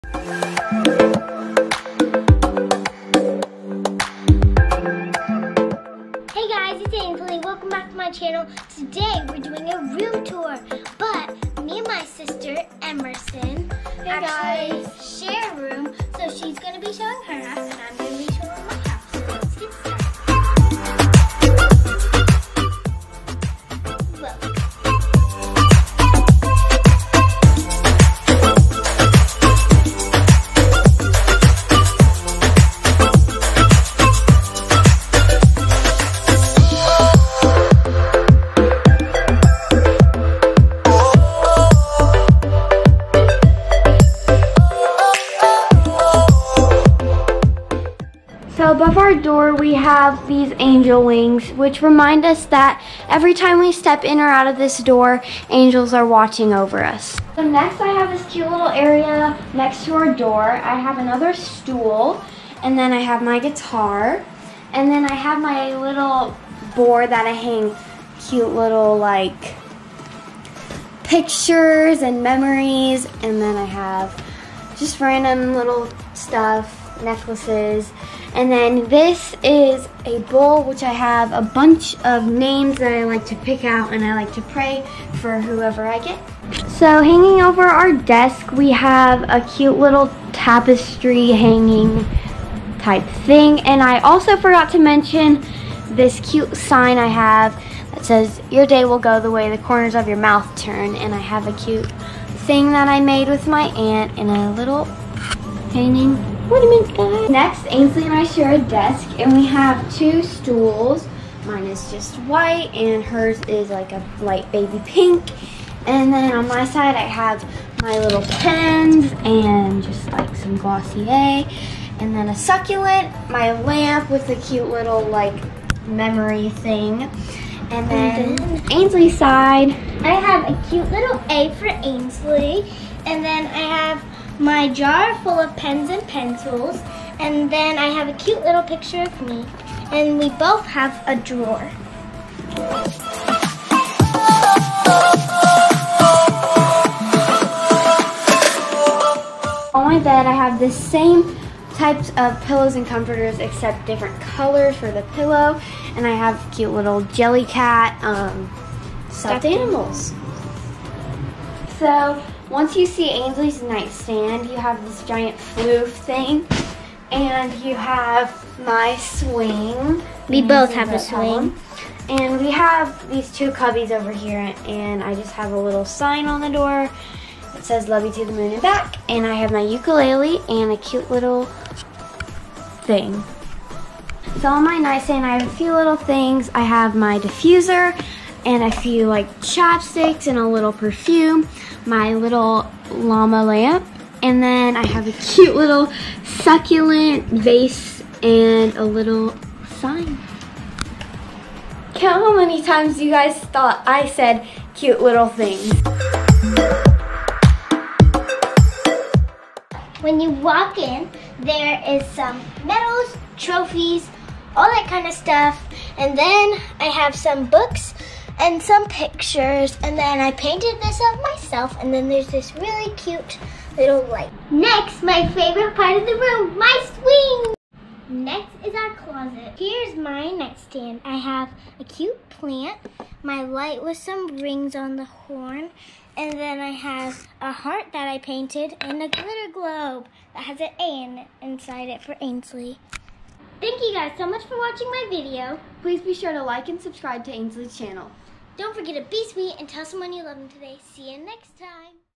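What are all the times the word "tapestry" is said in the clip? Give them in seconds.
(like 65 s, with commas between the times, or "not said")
90 s.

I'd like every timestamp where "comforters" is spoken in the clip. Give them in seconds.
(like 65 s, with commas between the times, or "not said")
152 s.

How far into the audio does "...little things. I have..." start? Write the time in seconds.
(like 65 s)
185 s.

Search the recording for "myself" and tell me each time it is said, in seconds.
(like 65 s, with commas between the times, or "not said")
221 s.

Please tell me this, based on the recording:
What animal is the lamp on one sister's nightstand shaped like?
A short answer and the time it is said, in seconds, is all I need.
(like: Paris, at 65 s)
Llama, at 192 s.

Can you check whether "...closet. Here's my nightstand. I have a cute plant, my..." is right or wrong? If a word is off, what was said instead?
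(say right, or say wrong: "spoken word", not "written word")
right.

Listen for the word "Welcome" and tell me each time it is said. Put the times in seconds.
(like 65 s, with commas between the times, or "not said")
7 s.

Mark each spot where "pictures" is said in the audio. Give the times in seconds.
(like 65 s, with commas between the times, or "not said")
71 s, 138 s, 218 s.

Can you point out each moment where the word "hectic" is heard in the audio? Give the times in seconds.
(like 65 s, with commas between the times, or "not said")
not said.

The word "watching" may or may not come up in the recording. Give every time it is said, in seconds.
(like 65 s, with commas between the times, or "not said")
56 s, 244 s.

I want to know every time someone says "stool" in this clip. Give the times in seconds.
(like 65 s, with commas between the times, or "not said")
61 s, 110 s.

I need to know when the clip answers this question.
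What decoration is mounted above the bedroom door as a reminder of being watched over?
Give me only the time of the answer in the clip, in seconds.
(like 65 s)
50 s.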